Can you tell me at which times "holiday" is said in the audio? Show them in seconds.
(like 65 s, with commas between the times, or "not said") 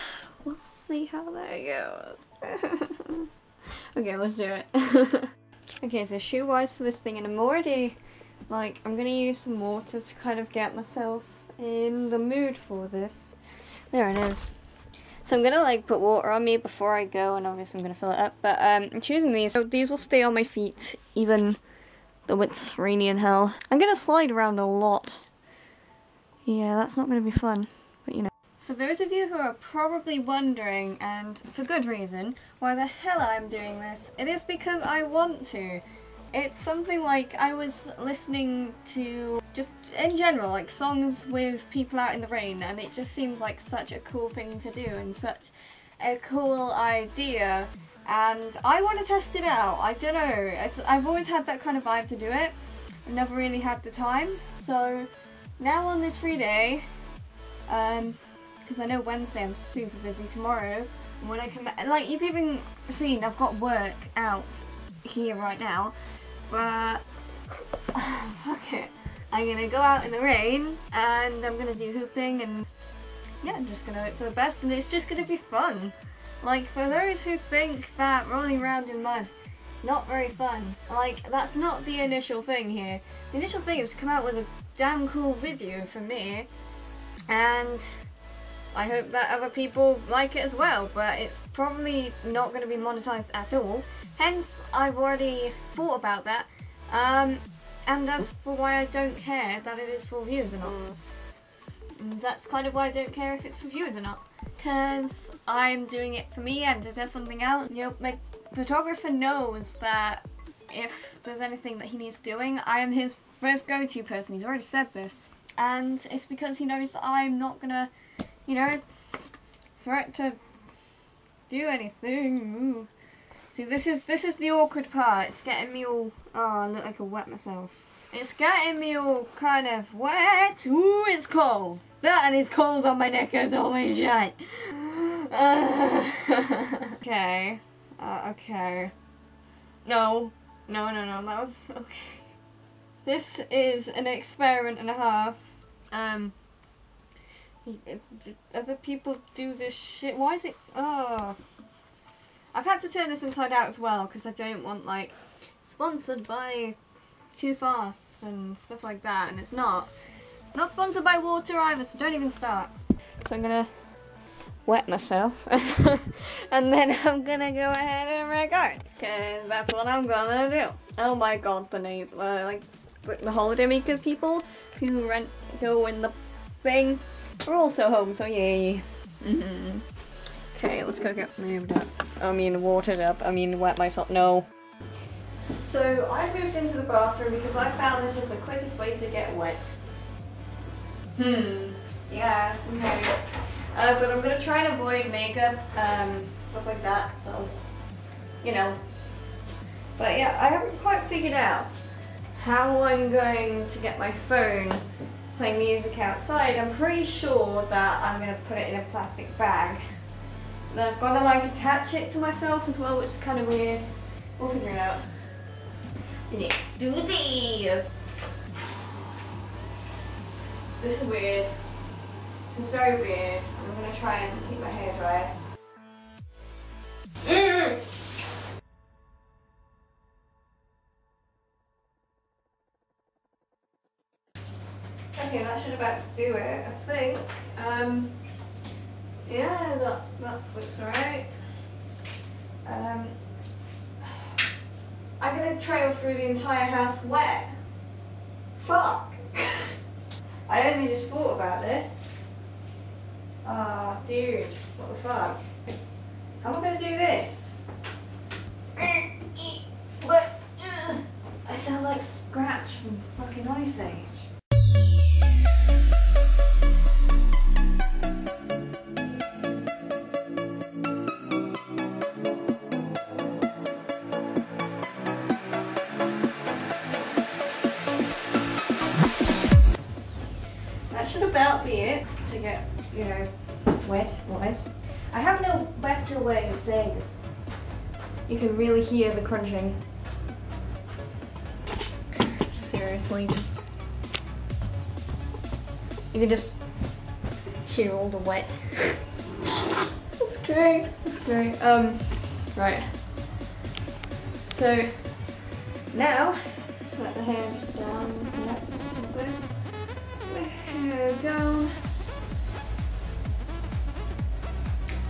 173 s.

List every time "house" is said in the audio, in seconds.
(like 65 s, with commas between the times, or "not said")
246 s.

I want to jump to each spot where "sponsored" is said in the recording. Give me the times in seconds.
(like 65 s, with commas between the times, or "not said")
155 s, 160 s.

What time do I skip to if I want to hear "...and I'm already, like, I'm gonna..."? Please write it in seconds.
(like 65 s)
7 s.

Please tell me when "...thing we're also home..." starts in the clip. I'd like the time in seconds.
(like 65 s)
176 s.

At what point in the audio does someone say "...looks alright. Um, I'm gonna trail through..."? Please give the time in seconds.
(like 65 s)
240 s.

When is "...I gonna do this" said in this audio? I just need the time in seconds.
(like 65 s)
256 s.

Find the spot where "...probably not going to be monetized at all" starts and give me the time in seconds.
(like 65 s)
91 s.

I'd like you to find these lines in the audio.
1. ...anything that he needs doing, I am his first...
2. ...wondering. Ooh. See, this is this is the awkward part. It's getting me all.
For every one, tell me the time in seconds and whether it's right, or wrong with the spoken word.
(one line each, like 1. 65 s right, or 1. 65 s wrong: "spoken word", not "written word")
1. 111 s right
2. 121 s wrong: "anything", not "wondering".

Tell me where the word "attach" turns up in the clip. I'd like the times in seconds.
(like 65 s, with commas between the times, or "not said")
211 s.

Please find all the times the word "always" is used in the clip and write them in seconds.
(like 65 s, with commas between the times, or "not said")
51 s, 133 s.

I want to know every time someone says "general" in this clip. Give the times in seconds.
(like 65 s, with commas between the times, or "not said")
40 s.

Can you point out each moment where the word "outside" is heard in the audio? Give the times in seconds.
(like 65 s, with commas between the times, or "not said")
205 s.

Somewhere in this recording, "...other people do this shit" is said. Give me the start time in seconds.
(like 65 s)
148 s.